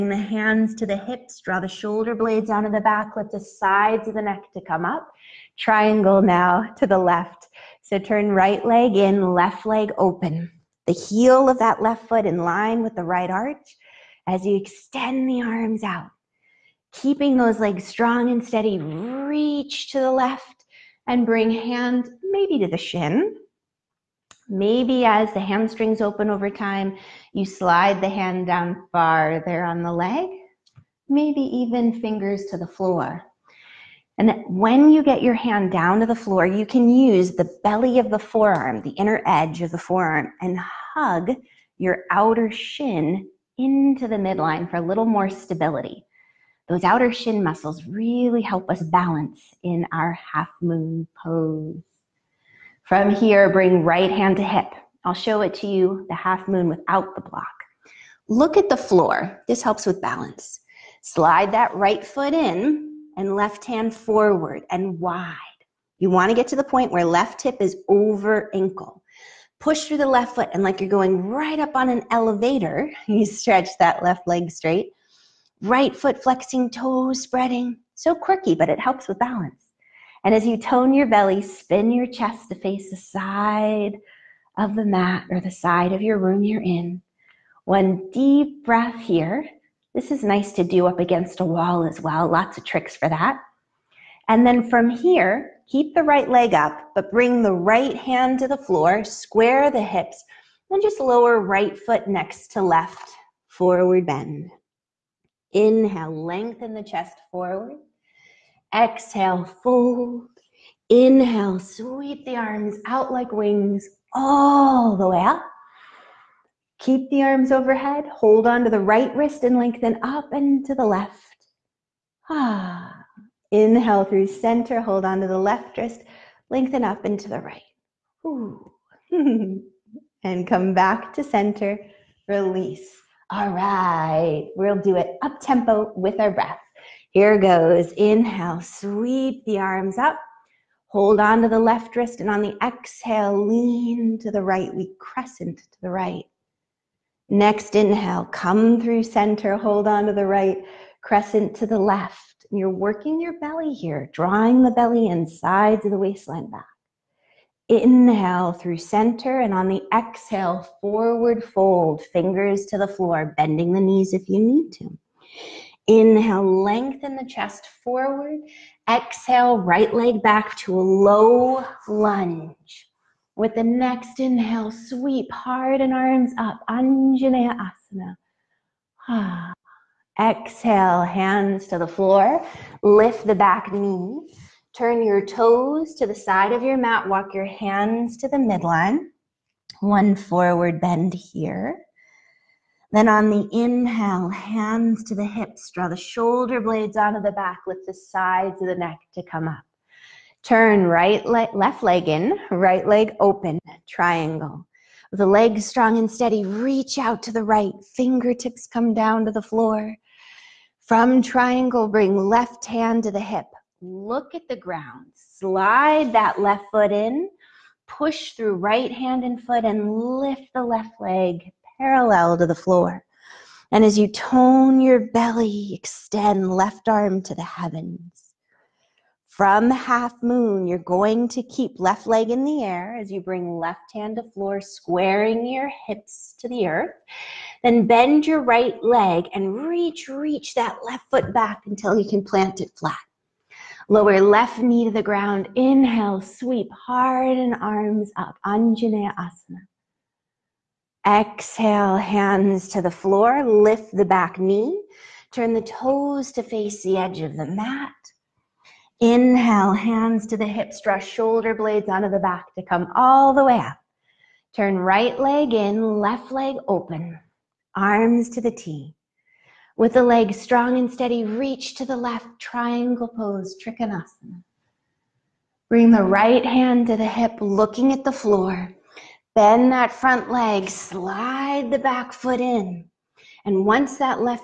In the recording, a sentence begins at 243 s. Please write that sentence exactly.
Lower left knee to the ground.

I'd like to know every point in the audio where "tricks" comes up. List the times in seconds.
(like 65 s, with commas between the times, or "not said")
92 s.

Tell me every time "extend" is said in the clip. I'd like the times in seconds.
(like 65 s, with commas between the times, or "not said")
14 s, 225 s.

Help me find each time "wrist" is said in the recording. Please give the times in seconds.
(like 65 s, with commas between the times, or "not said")
119 s, 125 s, 141 s.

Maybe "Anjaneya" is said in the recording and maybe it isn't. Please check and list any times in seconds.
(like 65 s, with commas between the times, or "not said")
176 s, 248 s.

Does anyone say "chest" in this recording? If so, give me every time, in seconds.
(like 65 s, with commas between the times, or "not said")
82 s, 106 s, 167 s.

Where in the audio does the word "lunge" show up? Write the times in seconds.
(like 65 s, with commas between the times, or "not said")
171 s.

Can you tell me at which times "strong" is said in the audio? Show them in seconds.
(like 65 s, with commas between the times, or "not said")
17 s, 205 s, 270 s.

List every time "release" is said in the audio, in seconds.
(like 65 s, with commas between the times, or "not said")
132 s.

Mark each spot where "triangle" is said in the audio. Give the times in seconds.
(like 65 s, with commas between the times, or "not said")
5 s, 203 s, 211 s, 272 s.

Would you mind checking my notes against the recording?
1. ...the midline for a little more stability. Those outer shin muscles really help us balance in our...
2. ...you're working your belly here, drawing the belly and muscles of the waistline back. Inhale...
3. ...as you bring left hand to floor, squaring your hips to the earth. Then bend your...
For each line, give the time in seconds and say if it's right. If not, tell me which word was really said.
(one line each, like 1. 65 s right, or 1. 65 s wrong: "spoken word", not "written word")
1. 44 s right
2. 152 s wrong: "sides", not "muscles"
3. 233 s right.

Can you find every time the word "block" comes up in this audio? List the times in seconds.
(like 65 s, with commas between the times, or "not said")
57 s.